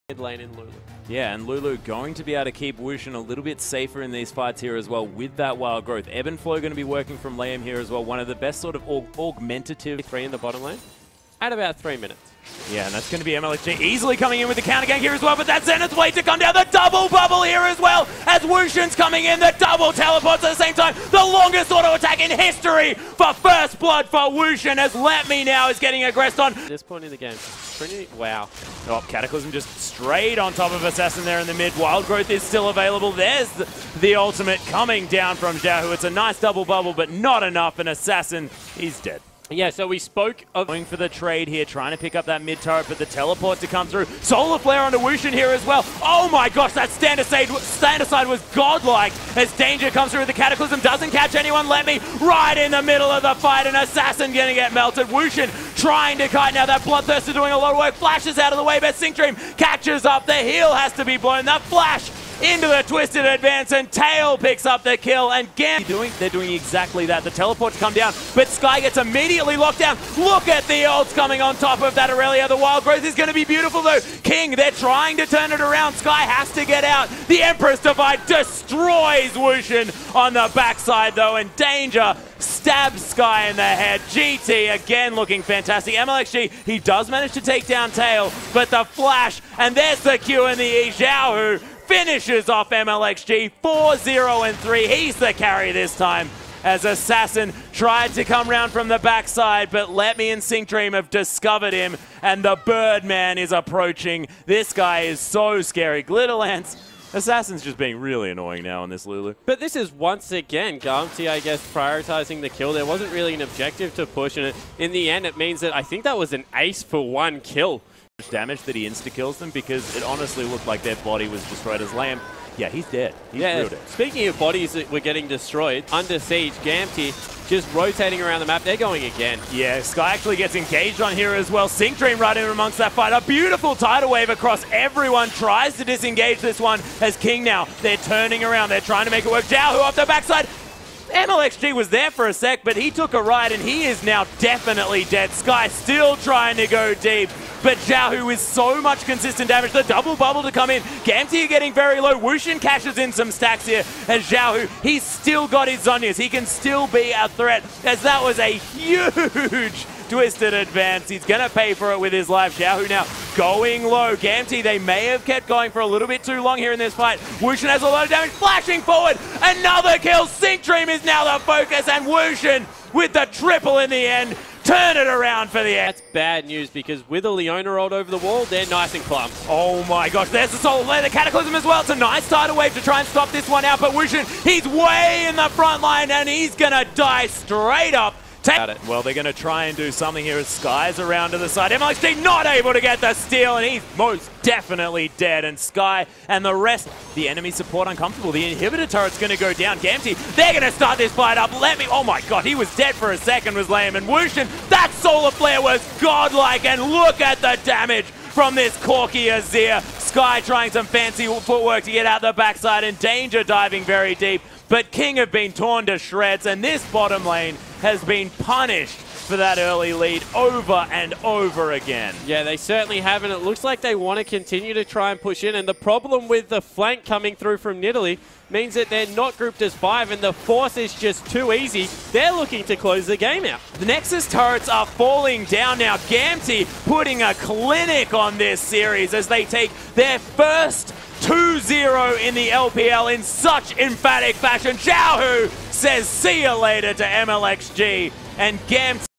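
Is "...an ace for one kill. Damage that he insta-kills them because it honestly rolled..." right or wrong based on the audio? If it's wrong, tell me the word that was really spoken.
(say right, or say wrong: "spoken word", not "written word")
wrong: "looked", not "rolled".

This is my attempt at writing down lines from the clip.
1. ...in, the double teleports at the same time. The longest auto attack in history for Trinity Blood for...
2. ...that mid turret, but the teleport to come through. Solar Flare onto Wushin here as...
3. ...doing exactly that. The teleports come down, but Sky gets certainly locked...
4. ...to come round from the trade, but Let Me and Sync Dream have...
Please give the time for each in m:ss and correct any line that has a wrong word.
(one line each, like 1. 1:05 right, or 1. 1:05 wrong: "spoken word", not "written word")
1. 0:19 wrong: "First", not "Trinity"
2. 0:42 right
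3. 1:06 wrong: "immediately", not "certainly"
4. 1:38 wrong: "backside", not "trade".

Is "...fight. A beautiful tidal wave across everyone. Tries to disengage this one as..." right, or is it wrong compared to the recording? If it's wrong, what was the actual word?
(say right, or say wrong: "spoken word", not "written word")
right.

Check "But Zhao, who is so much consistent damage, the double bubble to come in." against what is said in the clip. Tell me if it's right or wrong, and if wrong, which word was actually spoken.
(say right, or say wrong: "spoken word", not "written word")
right.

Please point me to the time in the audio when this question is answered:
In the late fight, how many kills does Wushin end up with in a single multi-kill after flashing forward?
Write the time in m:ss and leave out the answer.
2:53.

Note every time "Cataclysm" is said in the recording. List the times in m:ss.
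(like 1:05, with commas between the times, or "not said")
0:29, 0:50, 3:01.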